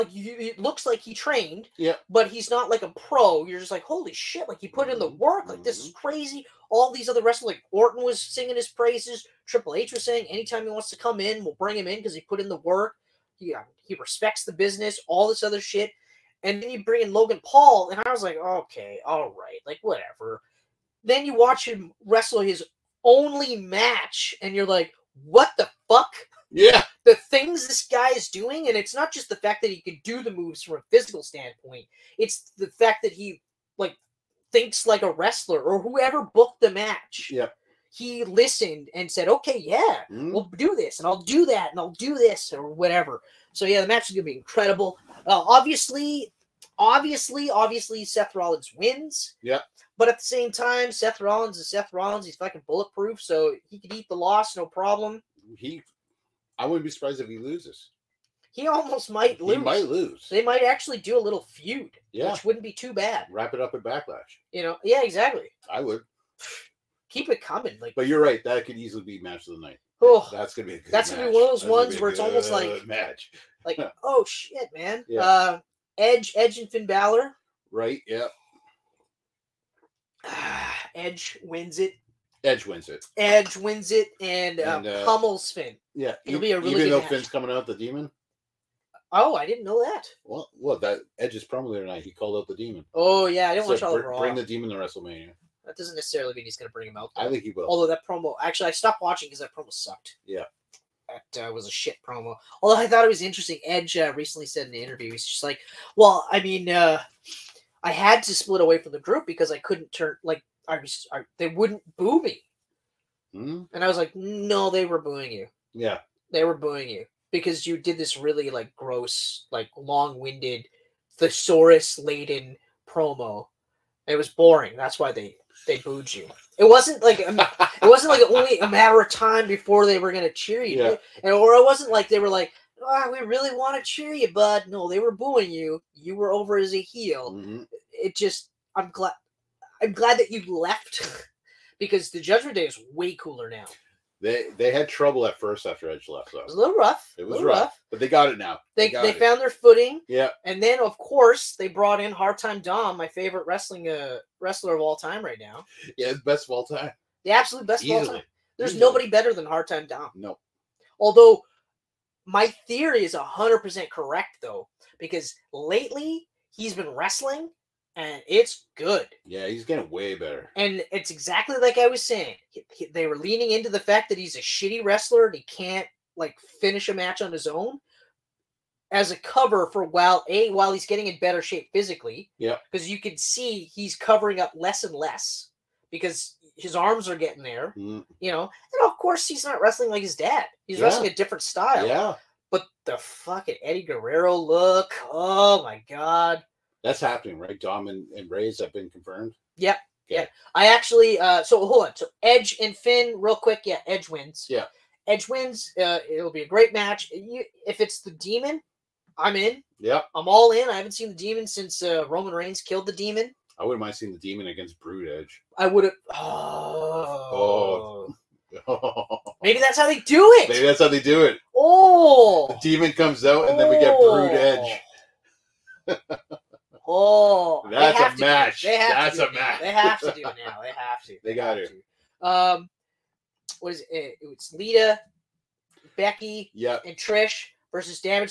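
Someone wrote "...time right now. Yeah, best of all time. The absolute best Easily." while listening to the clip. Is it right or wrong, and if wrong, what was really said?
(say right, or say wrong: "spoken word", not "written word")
right.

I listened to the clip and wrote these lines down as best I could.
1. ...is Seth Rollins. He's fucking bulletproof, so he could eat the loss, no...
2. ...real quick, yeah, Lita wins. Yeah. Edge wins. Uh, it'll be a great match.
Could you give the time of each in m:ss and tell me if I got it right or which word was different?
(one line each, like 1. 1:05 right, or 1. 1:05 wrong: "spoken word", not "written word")
1. 0:51 right
2. 3:23 wrong: "Edge", not "Lita".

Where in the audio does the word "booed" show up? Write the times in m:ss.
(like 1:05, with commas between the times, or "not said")
2:05.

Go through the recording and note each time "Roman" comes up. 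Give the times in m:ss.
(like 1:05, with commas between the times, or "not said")
3:32.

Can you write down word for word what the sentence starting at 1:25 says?
Yeah, it'll be a really even though match.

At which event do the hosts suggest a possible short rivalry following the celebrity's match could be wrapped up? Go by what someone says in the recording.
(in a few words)
Backlash.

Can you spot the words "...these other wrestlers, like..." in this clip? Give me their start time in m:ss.
0:06.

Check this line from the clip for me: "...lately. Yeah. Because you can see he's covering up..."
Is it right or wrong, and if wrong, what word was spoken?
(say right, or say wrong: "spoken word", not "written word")
wrong: "physically", not "lately".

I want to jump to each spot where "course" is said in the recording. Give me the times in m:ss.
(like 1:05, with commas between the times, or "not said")
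2:30, 3:08.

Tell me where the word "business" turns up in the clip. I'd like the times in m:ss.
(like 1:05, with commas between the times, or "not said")
0:14.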